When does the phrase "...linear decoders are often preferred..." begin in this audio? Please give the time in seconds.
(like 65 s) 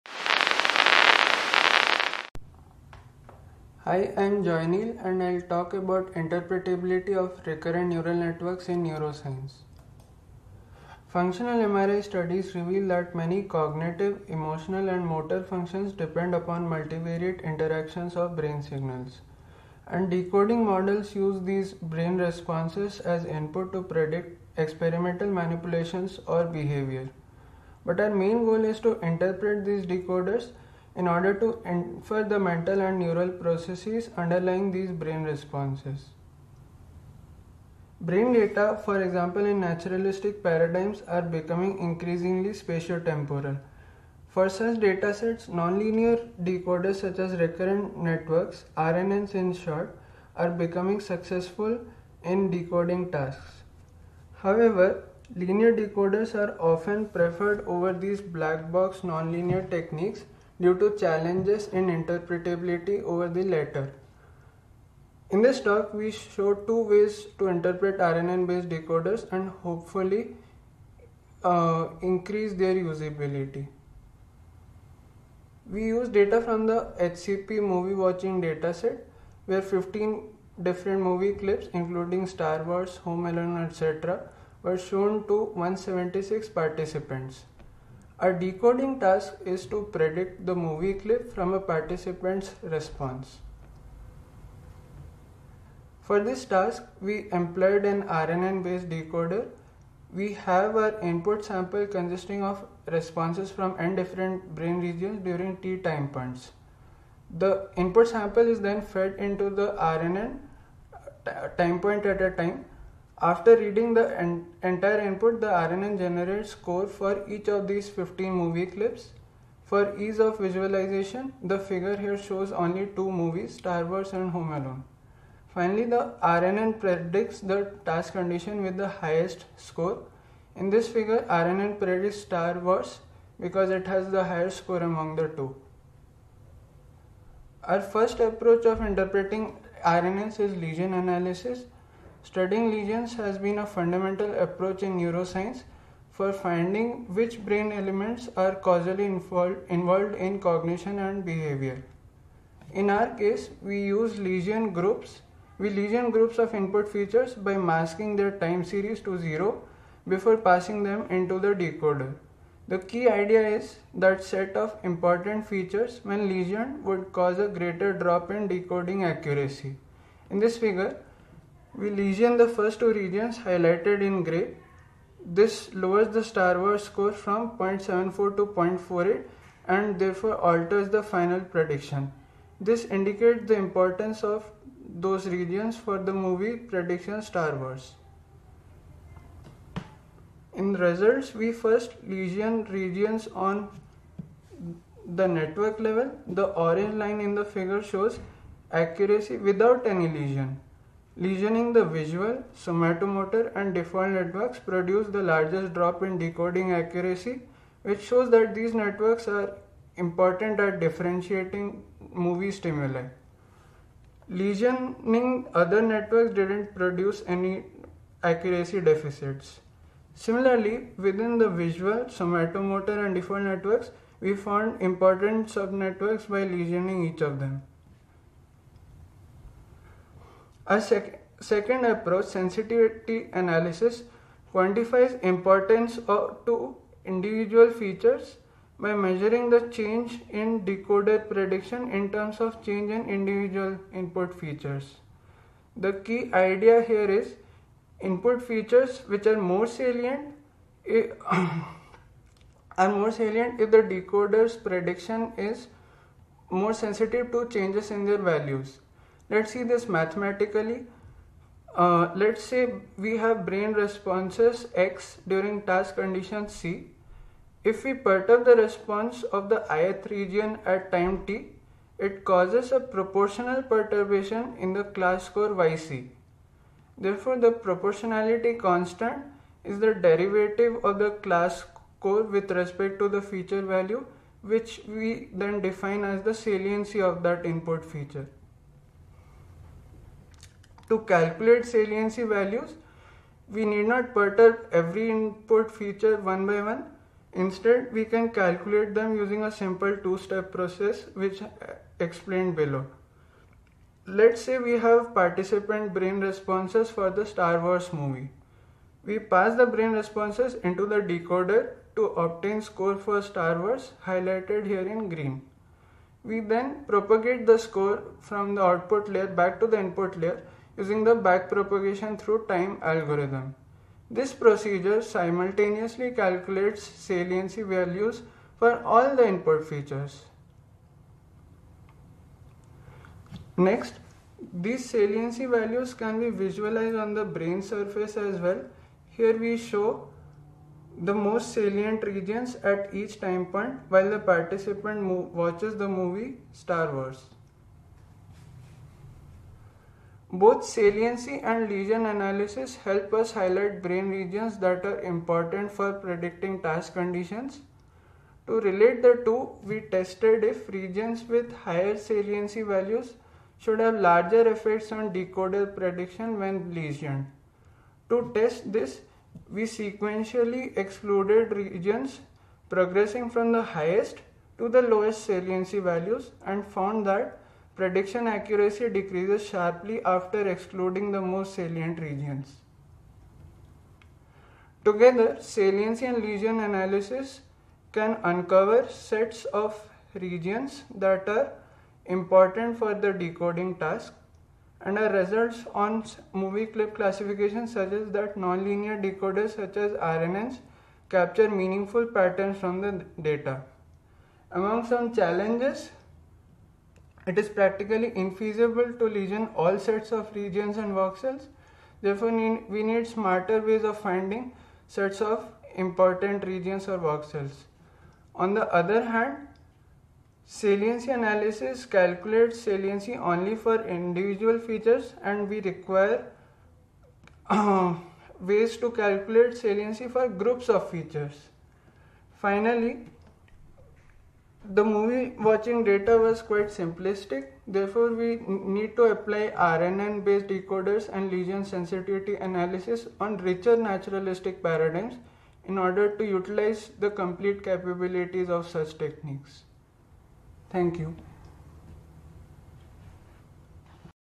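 55 s.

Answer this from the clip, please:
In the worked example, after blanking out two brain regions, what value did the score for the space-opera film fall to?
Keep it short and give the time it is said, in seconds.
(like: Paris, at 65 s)
0.48, at 178 s.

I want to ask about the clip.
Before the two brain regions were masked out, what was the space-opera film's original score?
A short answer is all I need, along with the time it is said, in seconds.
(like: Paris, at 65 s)
0.74, at 177 s.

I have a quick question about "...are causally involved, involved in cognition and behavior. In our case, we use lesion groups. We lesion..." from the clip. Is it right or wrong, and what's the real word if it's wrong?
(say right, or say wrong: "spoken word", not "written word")
right.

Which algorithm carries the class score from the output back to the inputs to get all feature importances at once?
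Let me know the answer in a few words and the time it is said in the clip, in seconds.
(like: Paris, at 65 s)
backpropagation through time, at 321 s.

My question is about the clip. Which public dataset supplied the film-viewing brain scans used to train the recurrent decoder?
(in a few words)
HCP movie watching dataset.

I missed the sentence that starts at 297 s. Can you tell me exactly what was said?
Instead, we can calculate them using a simple two-step process which uh, explained below.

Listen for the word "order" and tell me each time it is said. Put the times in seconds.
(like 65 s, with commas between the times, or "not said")
31 s, 445 s.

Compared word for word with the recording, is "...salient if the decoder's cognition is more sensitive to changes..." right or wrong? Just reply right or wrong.
wrong.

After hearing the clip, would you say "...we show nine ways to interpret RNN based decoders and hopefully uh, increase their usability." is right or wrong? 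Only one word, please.
wrong.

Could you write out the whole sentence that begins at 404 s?
Among some challenges it is practically infeasible to lesion all sets of regions and voxels.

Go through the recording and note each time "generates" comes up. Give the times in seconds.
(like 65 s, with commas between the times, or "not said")
115 s.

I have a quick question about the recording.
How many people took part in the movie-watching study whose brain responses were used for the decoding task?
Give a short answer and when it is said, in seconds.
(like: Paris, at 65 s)
176, at 85 s.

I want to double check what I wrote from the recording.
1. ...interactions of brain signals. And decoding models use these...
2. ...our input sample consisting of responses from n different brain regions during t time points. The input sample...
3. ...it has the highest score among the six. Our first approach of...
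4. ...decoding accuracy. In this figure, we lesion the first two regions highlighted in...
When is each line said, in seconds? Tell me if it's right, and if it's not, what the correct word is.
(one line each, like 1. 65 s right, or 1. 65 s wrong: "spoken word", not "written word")
1. 17 s right
2. 100 s right
3. 133 s wrong: "two", not "six"
4. 168 s right.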